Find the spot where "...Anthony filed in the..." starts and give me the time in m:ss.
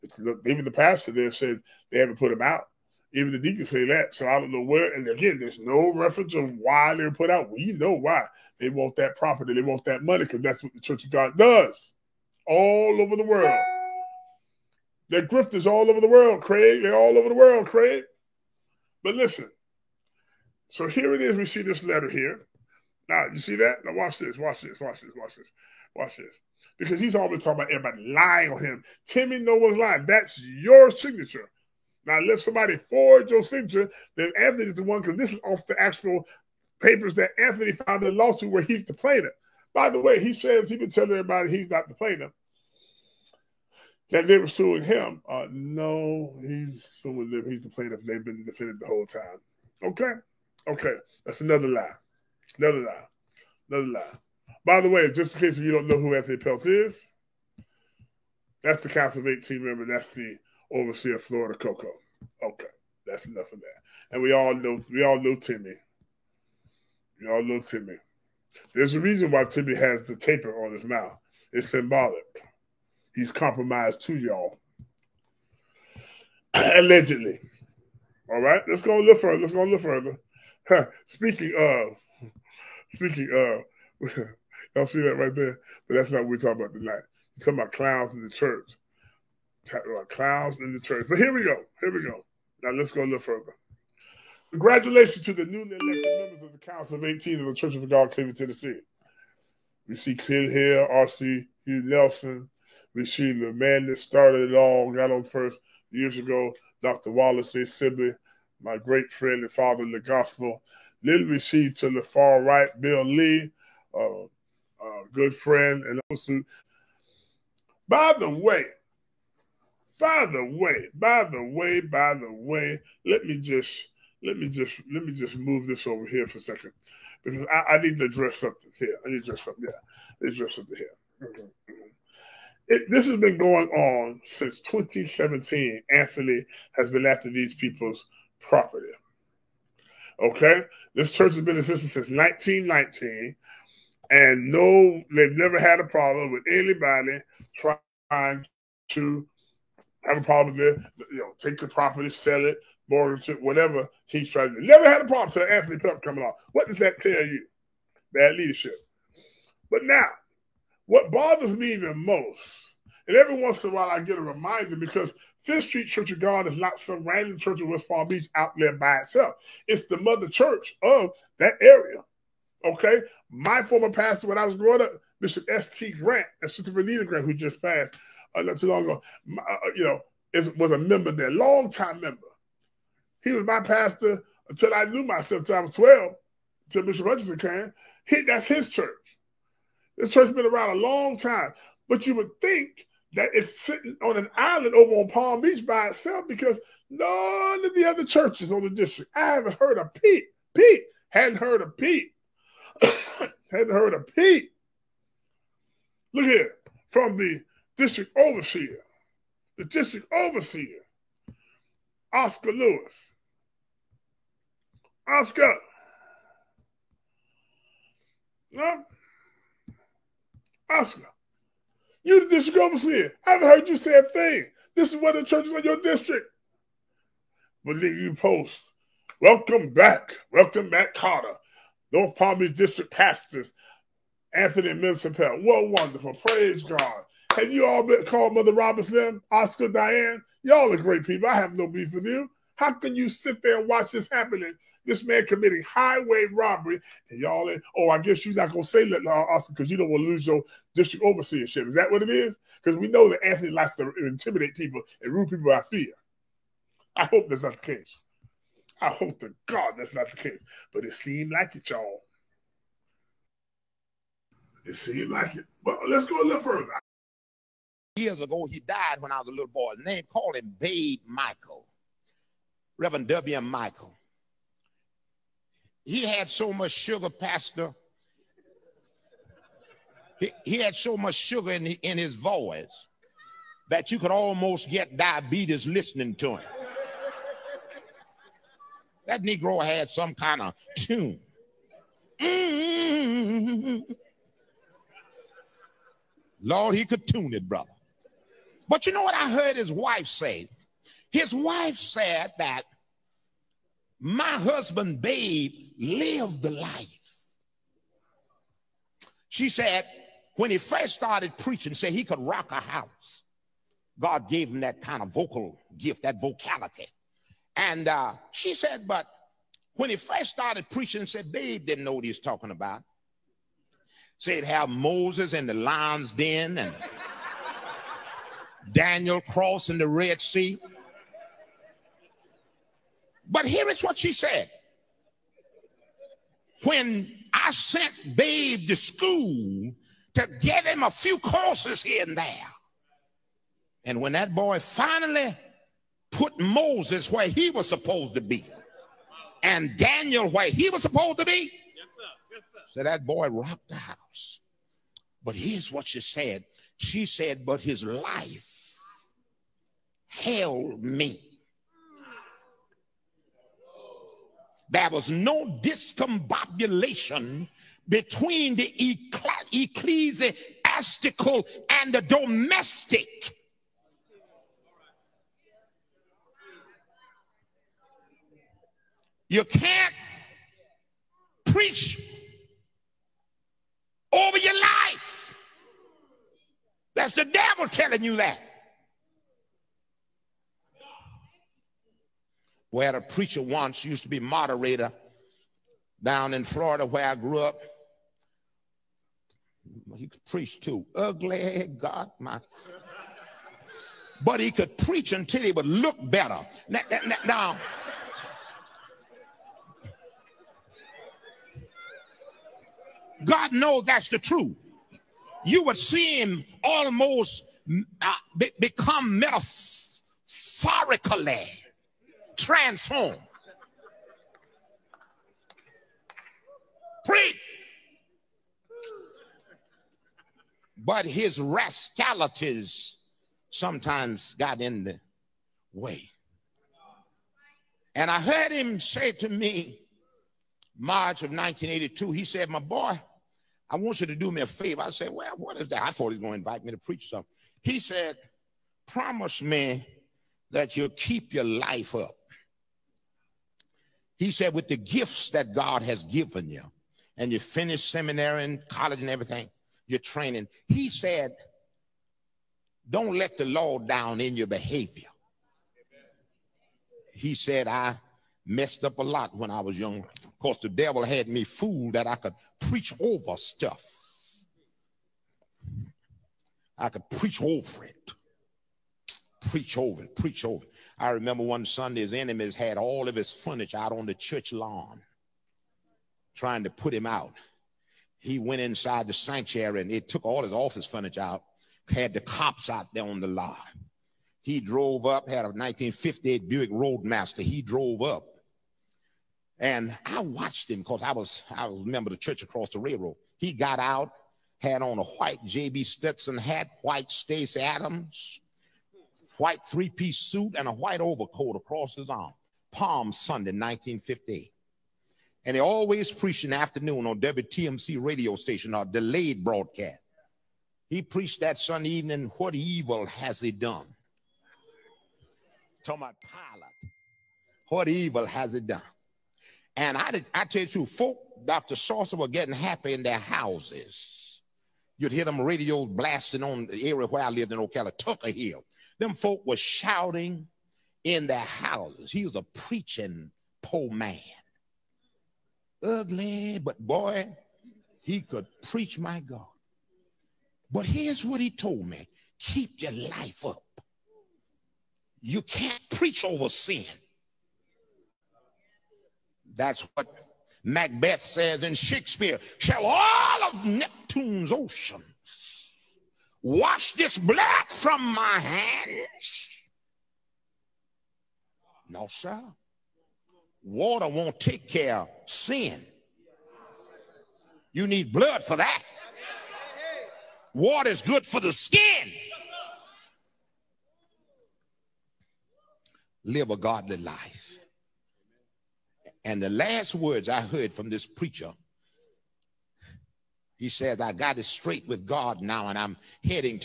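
0:37.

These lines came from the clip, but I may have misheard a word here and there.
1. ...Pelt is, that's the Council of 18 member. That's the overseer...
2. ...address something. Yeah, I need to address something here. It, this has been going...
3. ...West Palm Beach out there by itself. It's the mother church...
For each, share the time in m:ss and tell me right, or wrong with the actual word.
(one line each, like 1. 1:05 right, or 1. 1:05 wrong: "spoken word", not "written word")
1. 0:56 right
2. 2:09 right
3. 2:47 right.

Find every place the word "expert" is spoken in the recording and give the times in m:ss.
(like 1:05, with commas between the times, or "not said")
not said.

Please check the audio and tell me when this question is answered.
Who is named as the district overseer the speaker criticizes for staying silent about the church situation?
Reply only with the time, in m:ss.
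3:32.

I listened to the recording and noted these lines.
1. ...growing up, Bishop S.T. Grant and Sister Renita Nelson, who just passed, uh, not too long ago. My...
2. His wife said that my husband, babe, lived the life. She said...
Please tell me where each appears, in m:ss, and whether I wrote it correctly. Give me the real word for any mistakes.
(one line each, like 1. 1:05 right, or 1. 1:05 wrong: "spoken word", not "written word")
1. 2:54 wrong: "Grant", not "Nelson"
2. 5:01 right.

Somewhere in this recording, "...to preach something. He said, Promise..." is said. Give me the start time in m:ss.
7:26.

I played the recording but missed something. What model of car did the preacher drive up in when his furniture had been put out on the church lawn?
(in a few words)
Buick Roadmaster.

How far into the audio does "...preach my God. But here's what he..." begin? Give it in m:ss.
9:08.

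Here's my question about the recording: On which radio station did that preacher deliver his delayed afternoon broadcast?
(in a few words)
WTMC.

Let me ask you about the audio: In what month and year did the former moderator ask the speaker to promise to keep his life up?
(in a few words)
March 1982.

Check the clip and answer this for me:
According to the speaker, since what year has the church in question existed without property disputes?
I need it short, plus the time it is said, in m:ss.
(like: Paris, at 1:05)
1919, at 2:22.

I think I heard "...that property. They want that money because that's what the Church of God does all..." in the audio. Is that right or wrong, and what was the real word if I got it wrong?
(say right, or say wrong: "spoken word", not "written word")
right.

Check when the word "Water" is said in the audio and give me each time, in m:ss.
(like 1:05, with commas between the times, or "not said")
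9:33, 9:40.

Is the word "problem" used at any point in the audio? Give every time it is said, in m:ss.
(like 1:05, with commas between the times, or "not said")
2:25, 2:30, 2:35.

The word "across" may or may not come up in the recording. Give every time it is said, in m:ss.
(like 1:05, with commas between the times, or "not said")
8:22, 8:31.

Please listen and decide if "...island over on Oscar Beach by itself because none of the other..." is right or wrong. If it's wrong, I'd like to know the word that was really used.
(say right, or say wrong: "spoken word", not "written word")
wrong: "Palm", not "Oscar".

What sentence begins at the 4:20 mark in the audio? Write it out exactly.
But it seemed like it, y'all.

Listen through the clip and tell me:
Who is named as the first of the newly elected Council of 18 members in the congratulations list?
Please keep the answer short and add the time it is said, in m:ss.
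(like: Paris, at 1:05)
Clint Hill, at 1:40.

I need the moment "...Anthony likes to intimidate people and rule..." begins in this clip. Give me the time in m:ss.
4:13.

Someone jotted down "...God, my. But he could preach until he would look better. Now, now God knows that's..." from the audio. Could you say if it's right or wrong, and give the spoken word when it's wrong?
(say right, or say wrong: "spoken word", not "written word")
right.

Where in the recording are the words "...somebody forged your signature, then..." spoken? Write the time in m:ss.
0:32.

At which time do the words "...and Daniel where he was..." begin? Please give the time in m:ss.
5:49.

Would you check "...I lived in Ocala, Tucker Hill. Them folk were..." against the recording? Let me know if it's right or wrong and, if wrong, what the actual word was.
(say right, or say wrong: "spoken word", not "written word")
right.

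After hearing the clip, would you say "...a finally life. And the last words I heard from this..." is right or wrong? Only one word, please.
wrong.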